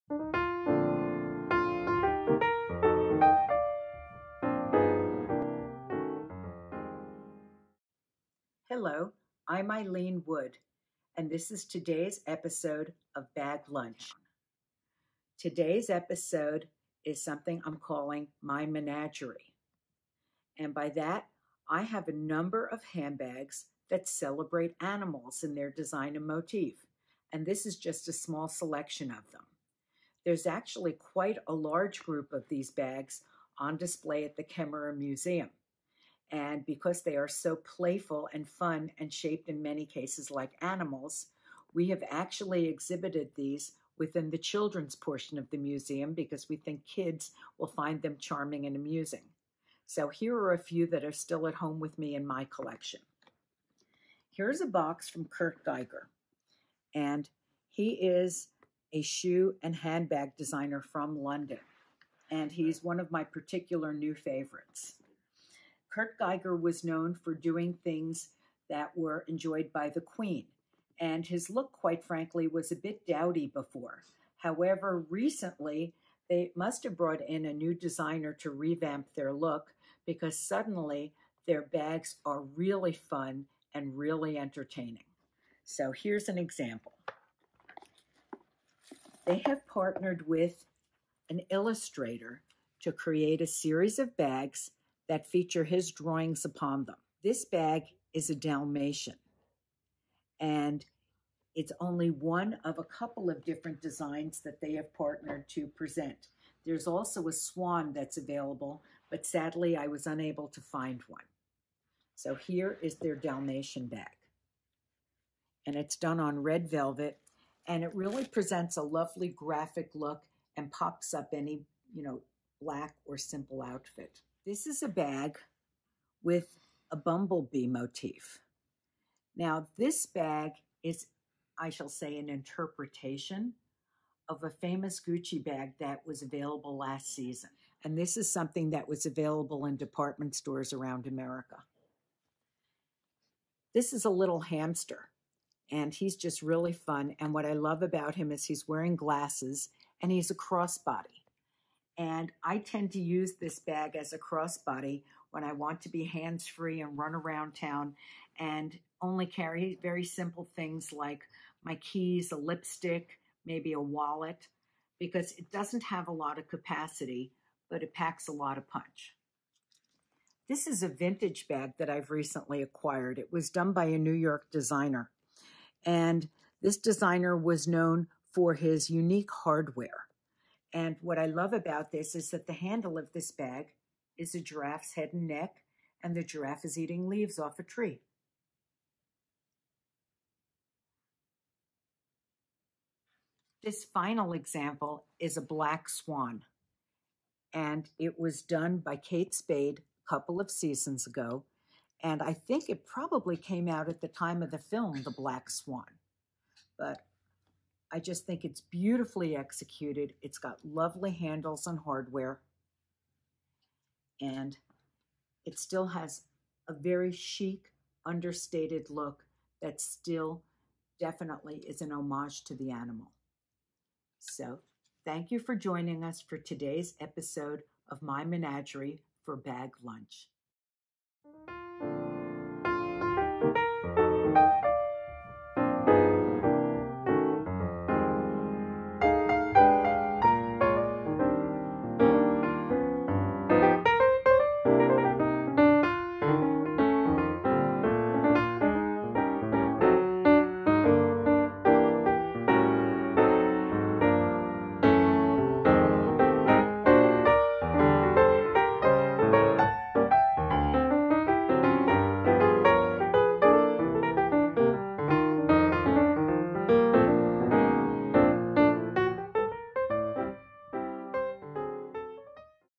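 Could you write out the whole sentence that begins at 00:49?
So here are a few that are still at home with me in my collection.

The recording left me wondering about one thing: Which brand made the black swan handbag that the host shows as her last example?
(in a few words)
Kate Spade.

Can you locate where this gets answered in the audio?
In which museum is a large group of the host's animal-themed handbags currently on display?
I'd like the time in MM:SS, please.
00:34.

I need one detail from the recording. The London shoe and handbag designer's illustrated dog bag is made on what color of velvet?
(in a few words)
Red.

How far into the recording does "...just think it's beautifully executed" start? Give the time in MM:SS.
03:27.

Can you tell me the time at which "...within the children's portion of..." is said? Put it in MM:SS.
00:43.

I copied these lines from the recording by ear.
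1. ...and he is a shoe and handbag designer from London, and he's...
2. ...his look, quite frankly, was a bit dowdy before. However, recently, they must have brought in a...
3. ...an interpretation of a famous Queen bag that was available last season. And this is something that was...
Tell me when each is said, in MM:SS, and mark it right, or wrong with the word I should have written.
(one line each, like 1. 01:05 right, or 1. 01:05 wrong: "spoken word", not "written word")
1. 00:56 right
2. 01:11 right
3. 02:12 wrong: "Gucci", not "Queen".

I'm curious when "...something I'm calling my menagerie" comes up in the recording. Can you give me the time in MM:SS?
00:17.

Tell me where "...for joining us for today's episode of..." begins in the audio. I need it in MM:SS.
03:45.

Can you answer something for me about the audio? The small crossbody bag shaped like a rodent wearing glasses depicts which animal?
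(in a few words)
Hamster.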